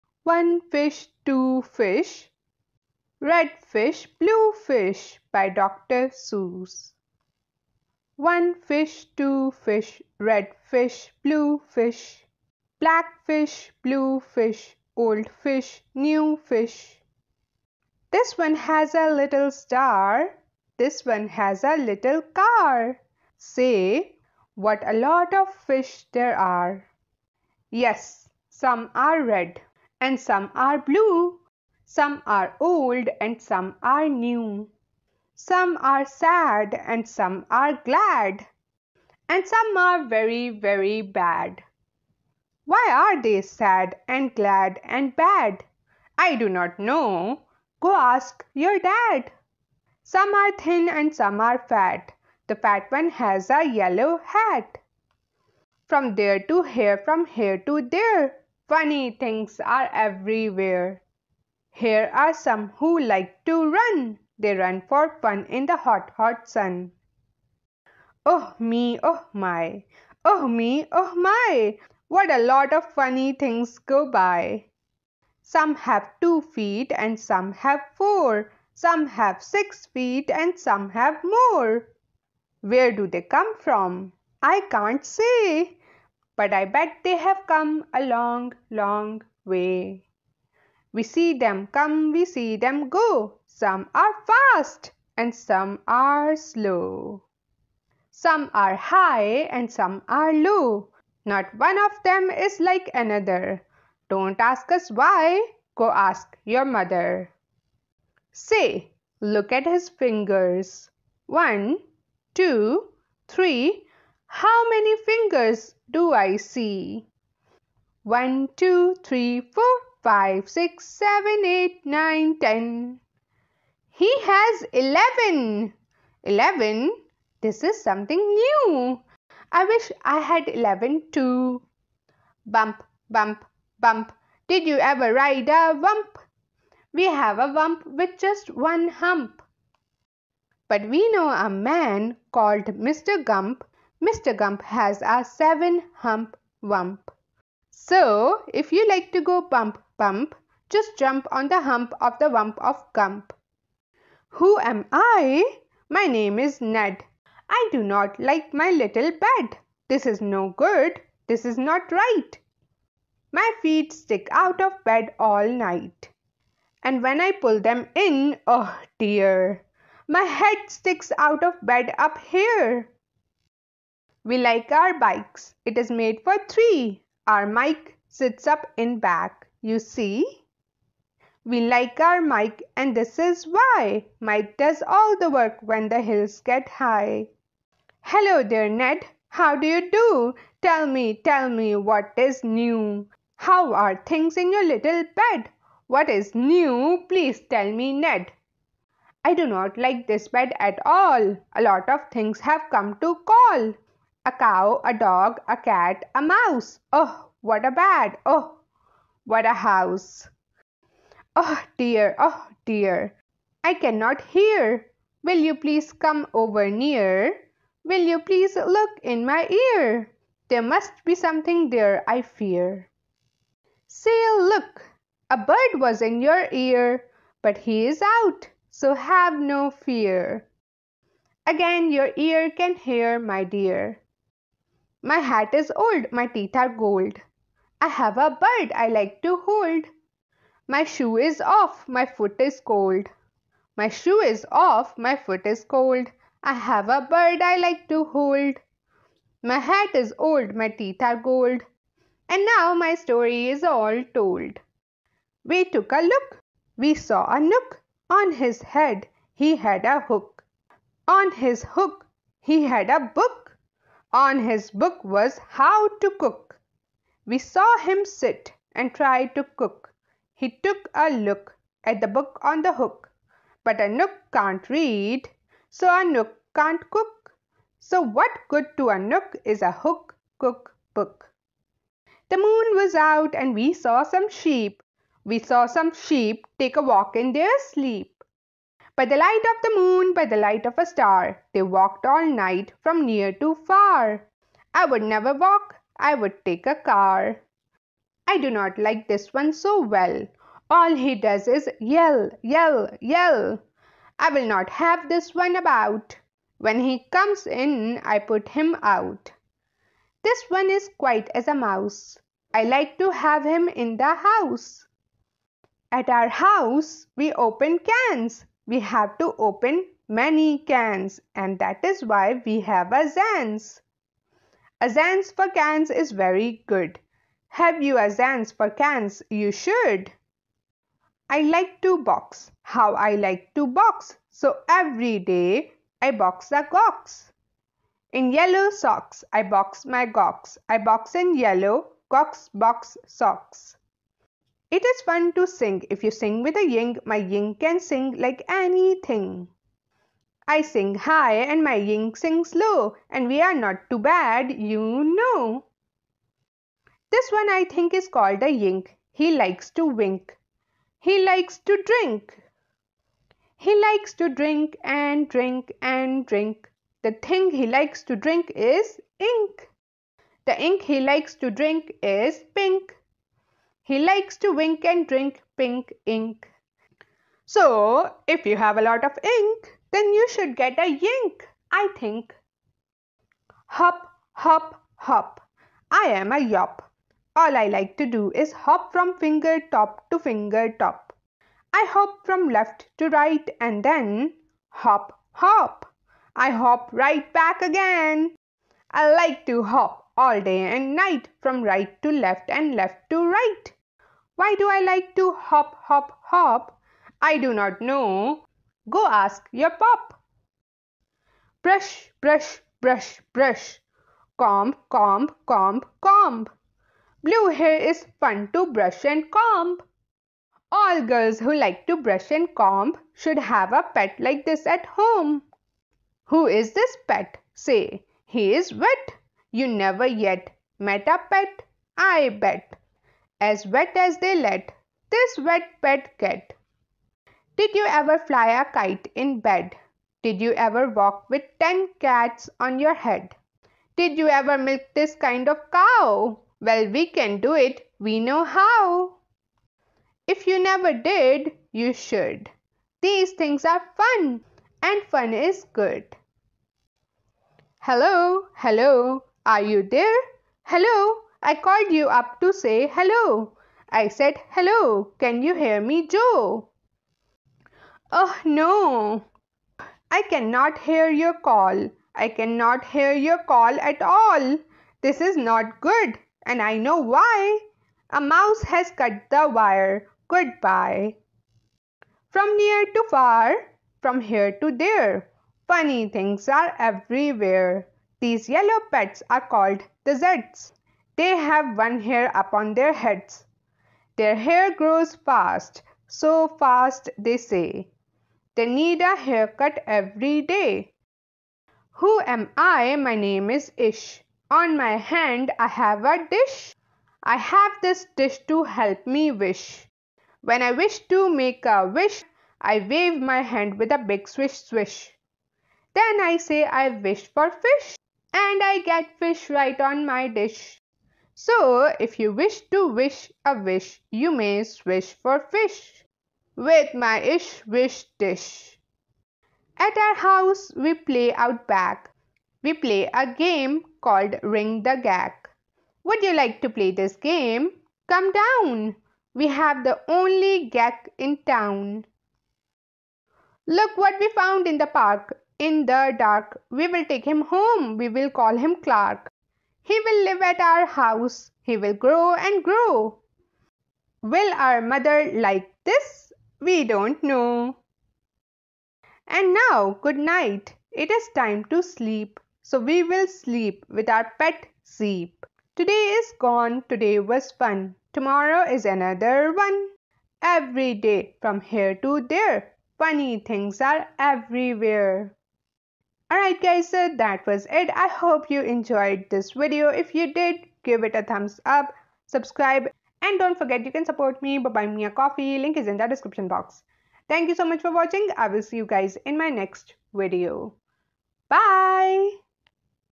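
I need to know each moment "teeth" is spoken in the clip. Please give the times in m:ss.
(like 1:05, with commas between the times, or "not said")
3:56, 4:10.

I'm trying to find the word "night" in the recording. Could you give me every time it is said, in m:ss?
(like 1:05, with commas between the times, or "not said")
2:45, 4:52, 6:40, 9:20.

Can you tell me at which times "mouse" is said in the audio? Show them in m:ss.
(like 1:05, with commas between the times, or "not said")
3:26, 5:11, 7:58.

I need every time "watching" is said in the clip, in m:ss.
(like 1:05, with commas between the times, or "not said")
9:47.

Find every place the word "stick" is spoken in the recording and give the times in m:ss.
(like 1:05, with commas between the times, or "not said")
2:43, 2:50.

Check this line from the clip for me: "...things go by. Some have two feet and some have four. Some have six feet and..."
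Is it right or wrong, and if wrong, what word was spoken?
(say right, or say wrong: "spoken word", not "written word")
right.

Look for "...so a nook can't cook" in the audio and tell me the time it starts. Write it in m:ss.
4:35.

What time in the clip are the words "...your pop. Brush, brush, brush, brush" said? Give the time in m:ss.
6:49.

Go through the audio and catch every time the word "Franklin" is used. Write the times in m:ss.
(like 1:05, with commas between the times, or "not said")
not said.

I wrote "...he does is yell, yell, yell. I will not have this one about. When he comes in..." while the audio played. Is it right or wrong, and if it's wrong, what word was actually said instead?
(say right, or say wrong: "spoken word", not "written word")
right.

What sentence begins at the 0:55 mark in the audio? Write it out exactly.
From there to here, from here to there, Funny things are everywhere.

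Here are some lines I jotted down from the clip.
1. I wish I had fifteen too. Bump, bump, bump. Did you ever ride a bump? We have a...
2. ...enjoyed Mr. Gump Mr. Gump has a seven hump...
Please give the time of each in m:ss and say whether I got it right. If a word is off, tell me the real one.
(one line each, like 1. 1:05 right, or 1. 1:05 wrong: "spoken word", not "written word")
1. 2:09 wrong: "eleven", not "fifteen"
2. 2:22 wrong: "called", not "enjoyed".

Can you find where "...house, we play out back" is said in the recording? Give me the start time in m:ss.
8:50.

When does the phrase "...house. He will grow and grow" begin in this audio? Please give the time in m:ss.
9:10.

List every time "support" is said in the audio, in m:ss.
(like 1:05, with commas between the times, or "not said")
9:44.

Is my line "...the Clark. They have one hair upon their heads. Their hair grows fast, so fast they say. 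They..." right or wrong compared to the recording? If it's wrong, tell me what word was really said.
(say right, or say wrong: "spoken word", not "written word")
wrong: "Zeds", not "Clark".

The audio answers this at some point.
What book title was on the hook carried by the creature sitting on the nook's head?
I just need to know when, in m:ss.
4:25.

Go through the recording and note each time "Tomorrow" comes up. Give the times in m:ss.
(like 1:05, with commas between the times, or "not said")
9:28.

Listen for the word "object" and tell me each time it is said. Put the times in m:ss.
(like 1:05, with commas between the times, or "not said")
not said.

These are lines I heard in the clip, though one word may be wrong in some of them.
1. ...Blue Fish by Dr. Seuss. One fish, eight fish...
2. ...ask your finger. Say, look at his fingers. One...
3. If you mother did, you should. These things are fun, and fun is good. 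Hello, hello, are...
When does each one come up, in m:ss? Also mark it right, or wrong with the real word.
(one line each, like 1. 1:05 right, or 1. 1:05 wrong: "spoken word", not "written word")
1. 0:04 wrong: "two", not "eight"
2. 1:45 wrong: "mother", not "finger"
3. 7:30 wrong: "never", not "mother".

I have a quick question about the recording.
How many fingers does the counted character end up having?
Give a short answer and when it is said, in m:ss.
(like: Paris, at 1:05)
11, at 2:03.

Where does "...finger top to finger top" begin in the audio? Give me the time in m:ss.
6:29.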